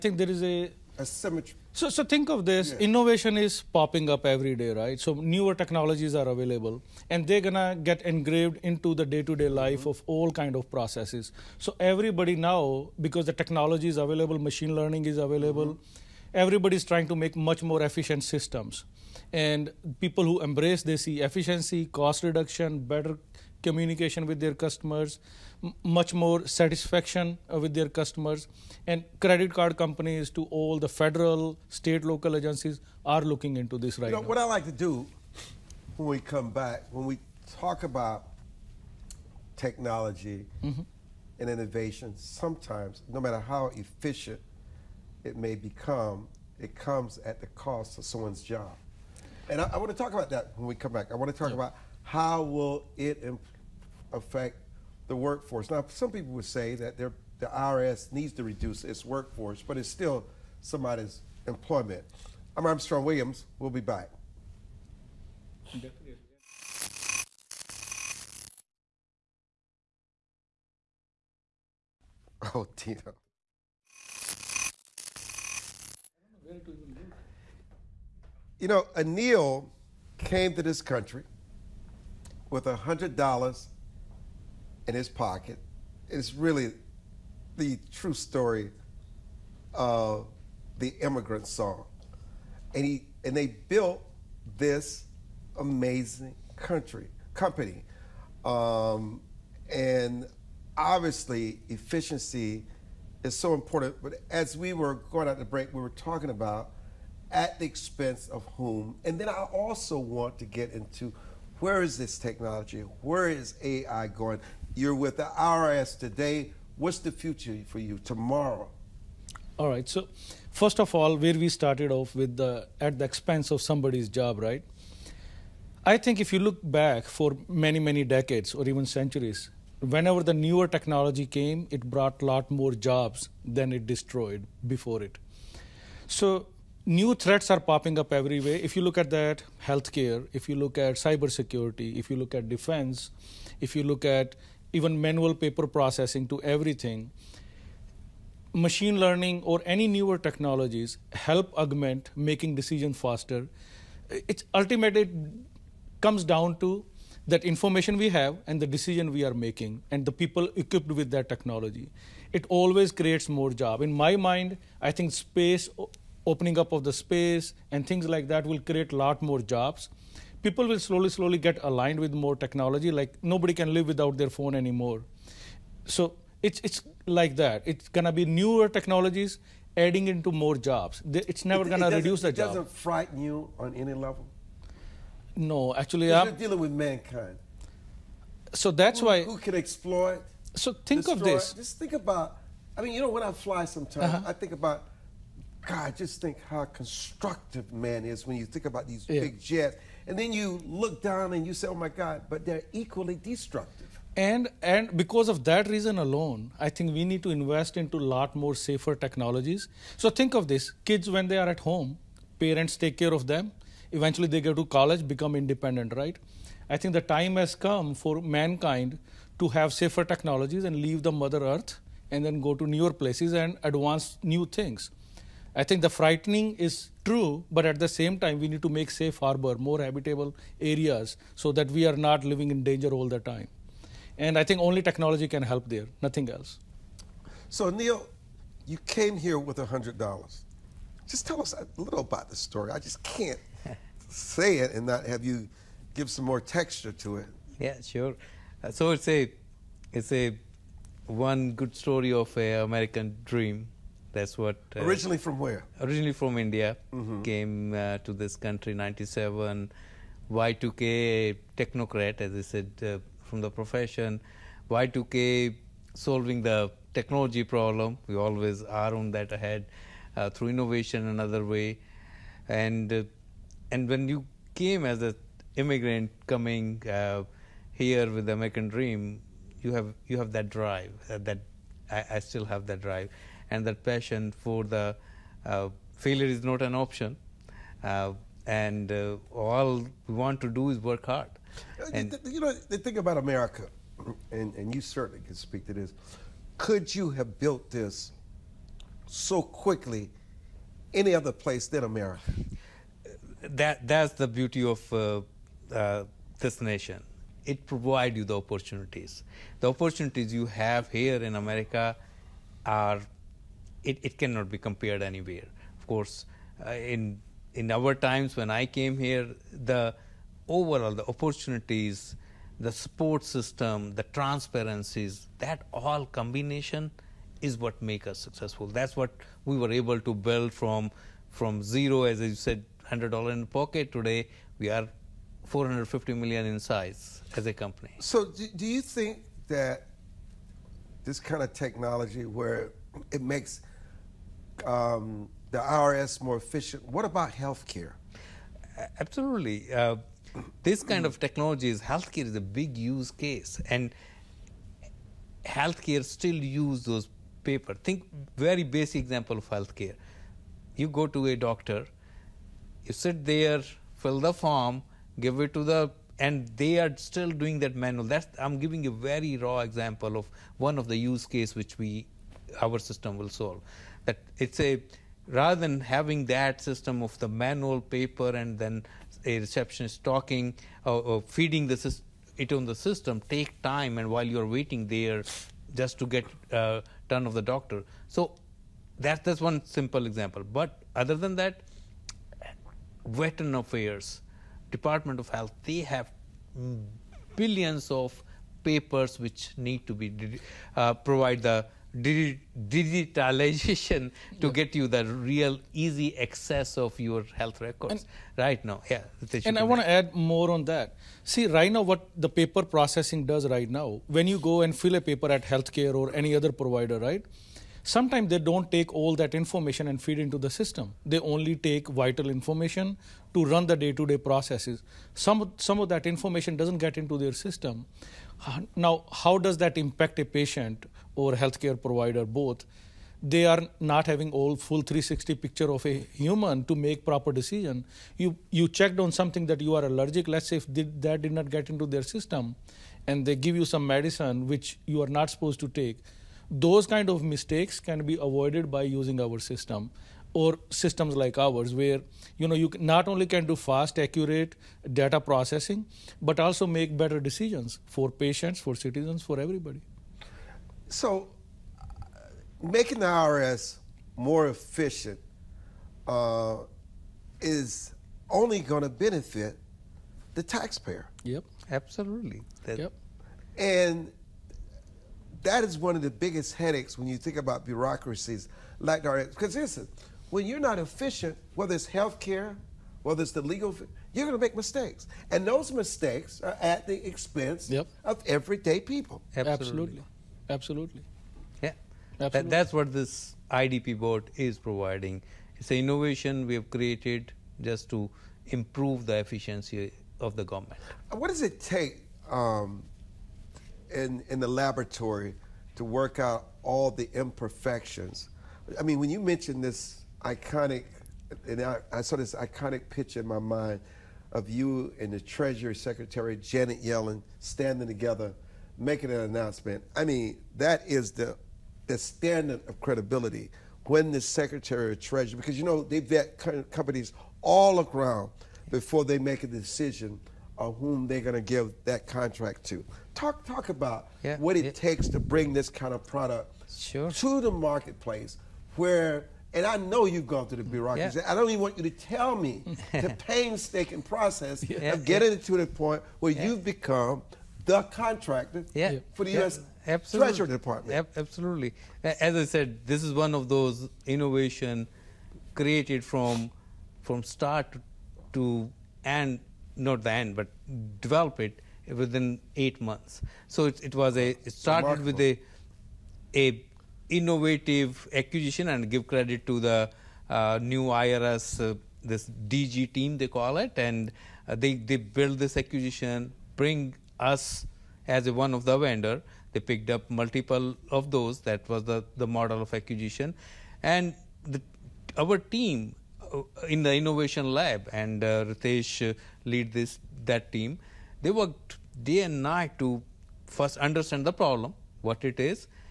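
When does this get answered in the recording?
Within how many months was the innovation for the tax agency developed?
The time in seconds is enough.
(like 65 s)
562 s.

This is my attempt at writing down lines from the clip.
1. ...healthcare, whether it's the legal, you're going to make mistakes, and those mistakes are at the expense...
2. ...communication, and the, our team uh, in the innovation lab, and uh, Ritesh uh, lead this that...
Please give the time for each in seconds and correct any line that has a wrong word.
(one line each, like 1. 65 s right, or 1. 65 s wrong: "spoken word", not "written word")
1. 481 s right
2. 582 s wrong: "acquisition", not "communication".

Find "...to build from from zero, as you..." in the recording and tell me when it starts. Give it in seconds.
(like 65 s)
330 s.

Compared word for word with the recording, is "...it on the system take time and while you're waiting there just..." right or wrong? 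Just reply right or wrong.
right.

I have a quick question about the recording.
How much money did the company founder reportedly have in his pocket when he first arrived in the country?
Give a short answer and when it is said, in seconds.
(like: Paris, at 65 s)
$100, at 82 s.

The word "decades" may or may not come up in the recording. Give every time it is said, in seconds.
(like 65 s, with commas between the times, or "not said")
128 s.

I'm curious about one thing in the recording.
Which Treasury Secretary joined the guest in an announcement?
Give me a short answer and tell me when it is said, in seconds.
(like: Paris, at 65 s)
Janet Yellen, at 516 s.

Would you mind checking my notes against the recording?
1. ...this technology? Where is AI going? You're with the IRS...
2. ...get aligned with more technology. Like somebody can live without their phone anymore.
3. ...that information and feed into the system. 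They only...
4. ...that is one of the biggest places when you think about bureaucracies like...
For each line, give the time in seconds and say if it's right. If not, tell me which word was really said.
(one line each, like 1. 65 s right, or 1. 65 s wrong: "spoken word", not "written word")
1. 111 s right
2. 171 s wrong: "nobody", not "somebody"
3. 419 s right
4. 475 s wrong: "headaches", not "places".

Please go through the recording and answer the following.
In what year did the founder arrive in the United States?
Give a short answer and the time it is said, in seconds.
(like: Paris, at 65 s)
1997, at 258 s.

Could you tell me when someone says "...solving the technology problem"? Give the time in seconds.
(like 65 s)
265 s.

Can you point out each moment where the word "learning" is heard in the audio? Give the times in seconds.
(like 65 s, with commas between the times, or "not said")
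14 s, 149 s.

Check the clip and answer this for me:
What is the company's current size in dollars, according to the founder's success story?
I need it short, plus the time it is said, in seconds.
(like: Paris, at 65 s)
450 million, at 335 s.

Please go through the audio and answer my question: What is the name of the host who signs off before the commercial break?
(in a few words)
Armstrong Williams.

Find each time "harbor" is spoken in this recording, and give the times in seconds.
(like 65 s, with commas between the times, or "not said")
229 s.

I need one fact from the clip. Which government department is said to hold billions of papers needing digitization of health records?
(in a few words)
Veteran Affairs.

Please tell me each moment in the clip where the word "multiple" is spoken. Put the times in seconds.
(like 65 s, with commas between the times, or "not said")
580 s.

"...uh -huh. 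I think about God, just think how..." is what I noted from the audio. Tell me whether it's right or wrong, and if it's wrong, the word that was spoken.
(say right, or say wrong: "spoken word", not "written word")
right.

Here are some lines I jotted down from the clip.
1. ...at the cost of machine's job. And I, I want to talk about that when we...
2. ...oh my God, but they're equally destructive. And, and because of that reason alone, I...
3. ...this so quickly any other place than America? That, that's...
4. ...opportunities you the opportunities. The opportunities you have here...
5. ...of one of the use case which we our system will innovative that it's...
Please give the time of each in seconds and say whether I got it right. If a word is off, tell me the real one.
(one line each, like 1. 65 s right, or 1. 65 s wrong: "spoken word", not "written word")
1. 47 s wrong: "someone", not "machine"
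2. 201 s right
3. 297 s right
4. 307 s wrong: "provides", not "opportunities"
5. 370 s wrong: "solve", not "innovative".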